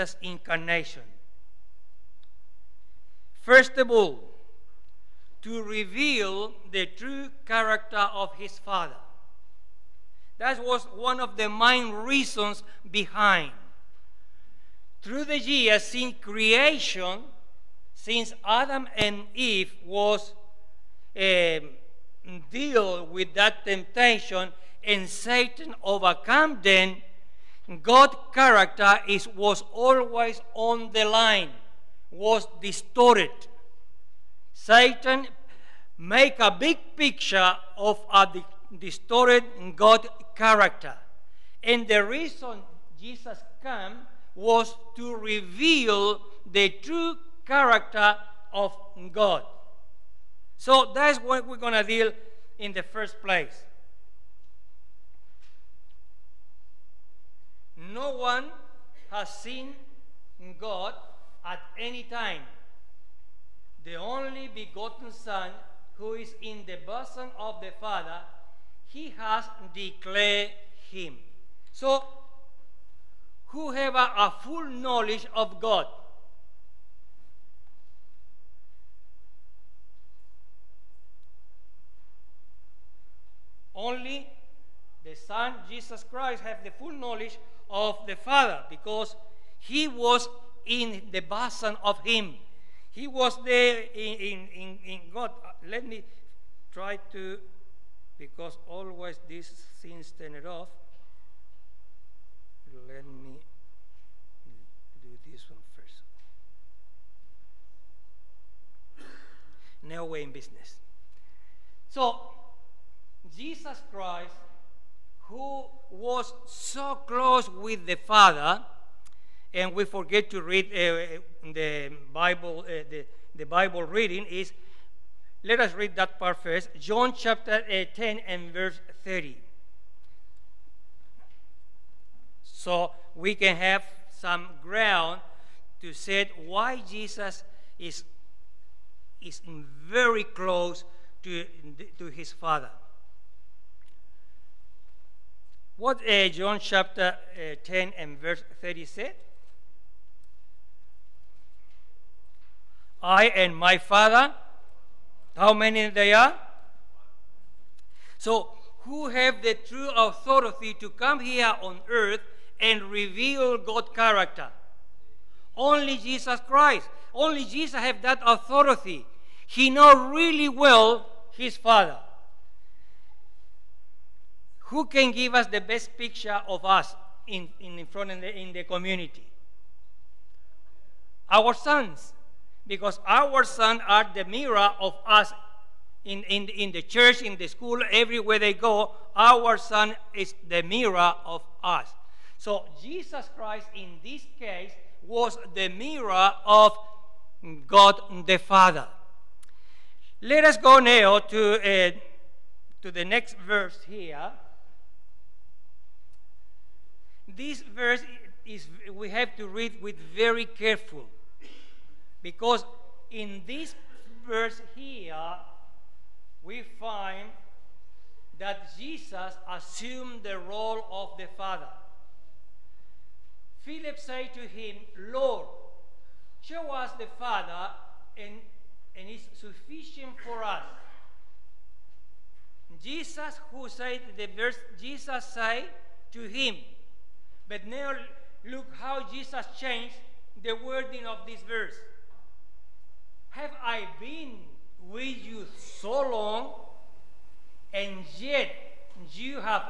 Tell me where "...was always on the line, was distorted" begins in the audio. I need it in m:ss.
0:29.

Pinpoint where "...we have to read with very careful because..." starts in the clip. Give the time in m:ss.
3:28.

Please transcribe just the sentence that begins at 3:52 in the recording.
Jesus, who said the verse, Jesus said to him, but now look how Jesus changed the wording of this verse.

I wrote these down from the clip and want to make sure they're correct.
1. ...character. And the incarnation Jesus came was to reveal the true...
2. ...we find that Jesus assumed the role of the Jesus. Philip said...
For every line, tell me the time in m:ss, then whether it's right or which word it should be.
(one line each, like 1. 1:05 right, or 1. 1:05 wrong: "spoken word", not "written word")
1. 0:40 wrong: "reason", not "incarnation"
2. 3:36 wrong: "Father", not "Jesus".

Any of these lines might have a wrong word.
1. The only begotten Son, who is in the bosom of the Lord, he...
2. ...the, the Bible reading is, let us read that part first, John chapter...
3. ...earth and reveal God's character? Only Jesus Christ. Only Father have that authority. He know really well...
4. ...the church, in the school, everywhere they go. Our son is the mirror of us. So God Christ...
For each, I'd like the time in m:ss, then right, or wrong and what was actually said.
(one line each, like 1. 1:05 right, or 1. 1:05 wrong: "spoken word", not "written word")
1. 1:03 wrong: "Father", not "Lord"
2. 2:02 right
3. 2:41 wrong: "Jesus", not "Father"
4. 3:06 wrong: "Jesus", not "God".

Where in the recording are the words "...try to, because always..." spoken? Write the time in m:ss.
1:36.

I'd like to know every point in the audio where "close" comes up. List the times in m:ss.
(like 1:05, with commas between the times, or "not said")
1:57, 2:20.